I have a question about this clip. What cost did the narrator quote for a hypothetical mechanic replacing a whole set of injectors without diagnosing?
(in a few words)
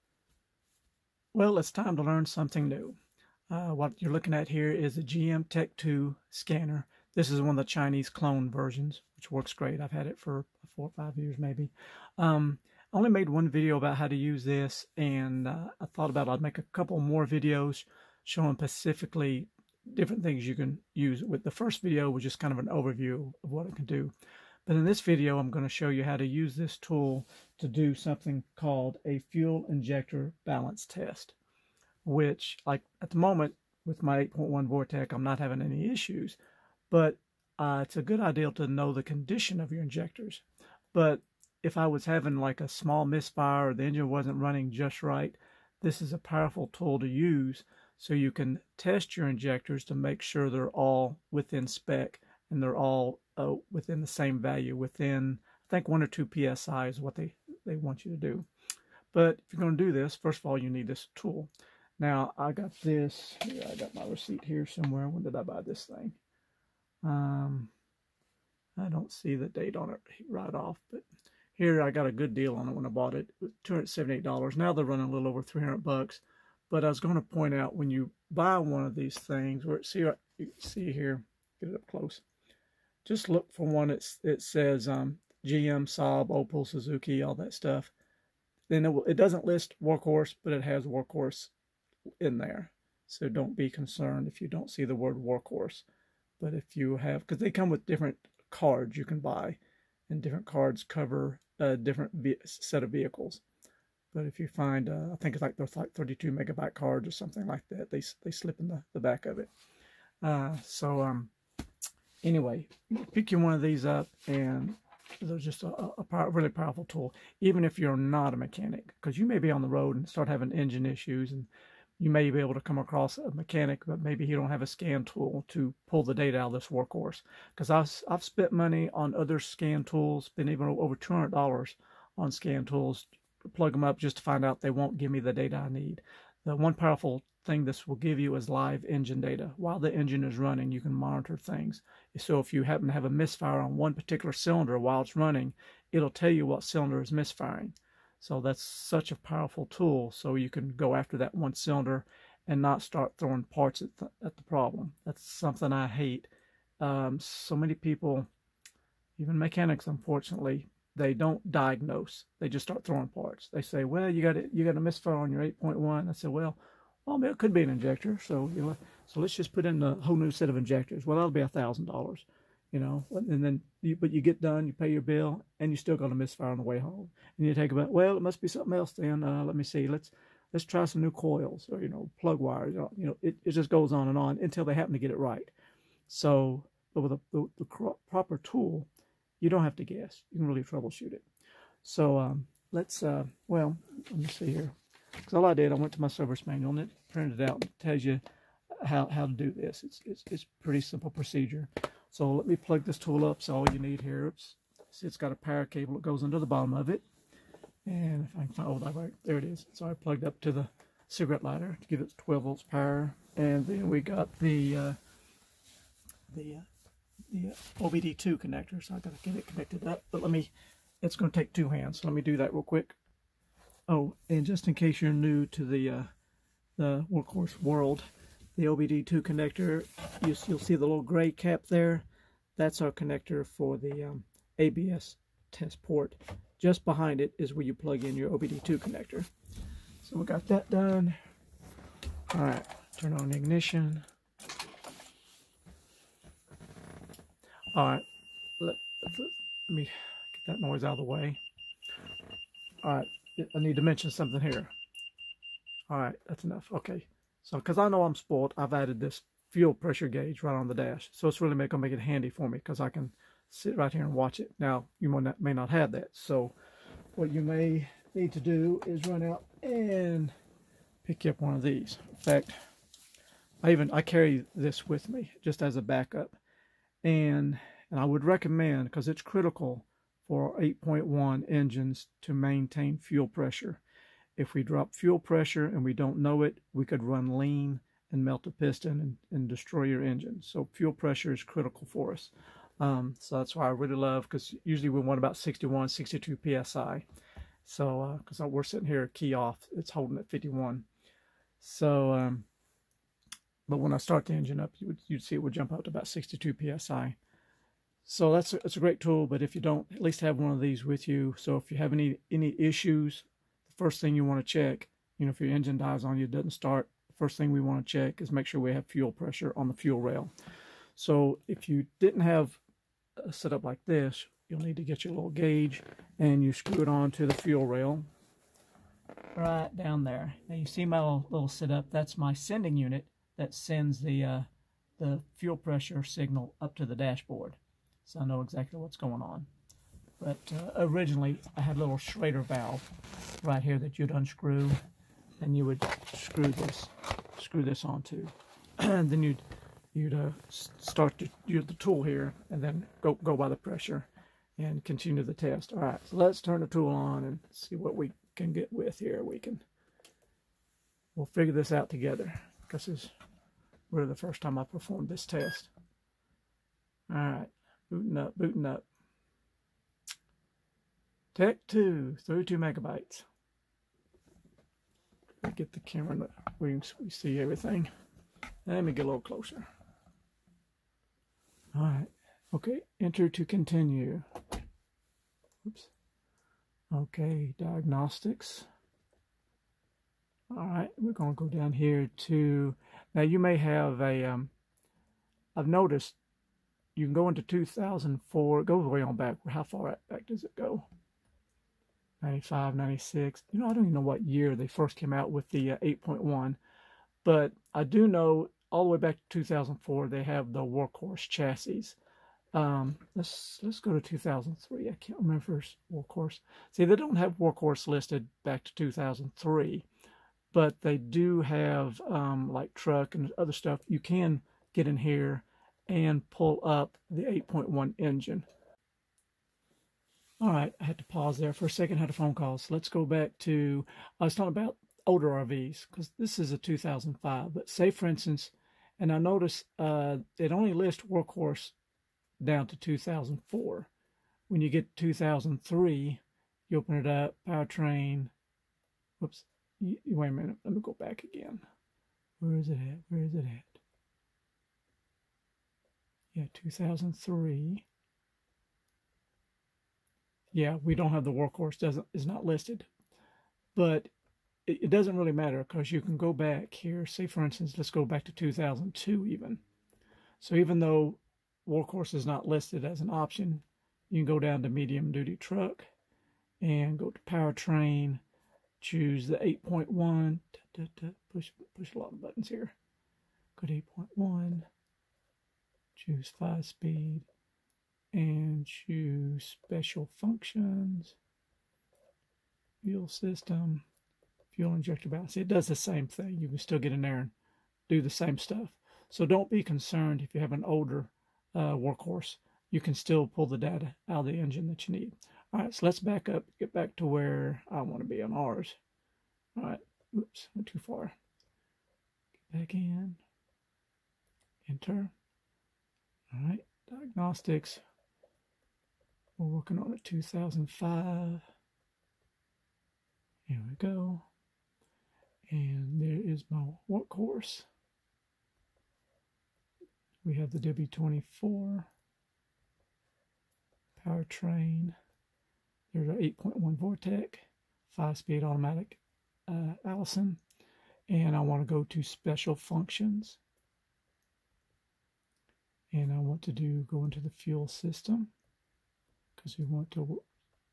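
$1,000.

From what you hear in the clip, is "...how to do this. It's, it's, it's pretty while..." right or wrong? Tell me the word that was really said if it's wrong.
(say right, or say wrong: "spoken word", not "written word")
wrong: "simple", not "while".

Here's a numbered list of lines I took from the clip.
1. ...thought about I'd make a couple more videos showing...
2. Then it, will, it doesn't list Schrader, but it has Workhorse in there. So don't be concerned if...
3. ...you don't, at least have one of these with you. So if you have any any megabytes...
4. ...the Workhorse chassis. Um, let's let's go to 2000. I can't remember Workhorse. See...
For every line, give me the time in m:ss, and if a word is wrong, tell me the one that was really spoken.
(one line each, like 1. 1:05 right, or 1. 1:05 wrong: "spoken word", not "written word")
1. 0:15 right
2. 1:28 wrong: "Workhorse", not "Schrader"
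3. 5:09 wrong: "issues", not "megabytes"
4. 6:50 wrong: "2003", not "2000".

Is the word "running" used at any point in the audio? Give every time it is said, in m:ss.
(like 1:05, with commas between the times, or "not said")
0:44, 1:14, 2:20, 2:25.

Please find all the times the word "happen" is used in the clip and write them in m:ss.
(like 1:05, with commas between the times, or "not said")
2:22, 3:04.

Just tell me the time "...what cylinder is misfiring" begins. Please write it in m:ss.
2:26.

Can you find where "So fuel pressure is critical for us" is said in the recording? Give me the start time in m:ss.
4:50.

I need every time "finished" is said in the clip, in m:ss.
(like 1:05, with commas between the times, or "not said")
not said.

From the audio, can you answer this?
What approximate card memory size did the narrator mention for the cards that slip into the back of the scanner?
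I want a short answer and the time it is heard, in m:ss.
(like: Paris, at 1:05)
32 megabyte, at 1:45.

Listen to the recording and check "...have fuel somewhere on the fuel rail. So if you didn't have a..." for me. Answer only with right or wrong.
wrong.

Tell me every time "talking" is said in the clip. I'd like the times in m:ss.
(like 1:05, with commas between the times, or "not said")
7:14.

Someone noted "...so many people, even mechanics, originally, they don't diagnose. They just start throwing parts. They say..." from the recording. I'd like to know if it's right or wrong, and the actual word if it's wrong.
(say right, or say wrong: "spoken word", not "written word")
wrong: "unfortunately", not "originally".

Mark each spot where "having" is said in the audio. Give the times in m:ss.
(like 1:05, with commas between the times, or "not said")
0:35, 0:42, 2:00.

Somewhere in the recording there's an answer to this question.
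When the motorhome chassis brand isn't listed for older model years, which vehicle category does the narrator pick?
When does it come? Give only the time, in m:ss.
7:54.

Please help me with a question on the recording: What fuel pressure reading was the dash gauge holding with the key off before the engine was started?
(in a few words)
51 PSI.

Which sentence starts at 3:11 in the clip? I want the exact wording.
So um, let's, uh, well, let me see here.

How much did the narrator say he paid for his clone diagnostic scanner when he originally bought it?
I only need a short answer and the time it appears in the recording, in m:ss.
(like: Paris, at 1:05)
$278, at 1:13.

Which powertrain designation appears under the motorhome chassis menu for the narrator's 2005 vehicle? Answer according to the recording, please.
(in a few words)
W24.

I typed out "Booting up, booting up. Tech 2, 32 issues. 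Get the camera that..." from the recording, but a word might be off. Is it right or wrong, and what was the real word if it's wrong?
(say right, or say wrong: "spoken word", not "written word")
wrong: "megabytes", not "issues".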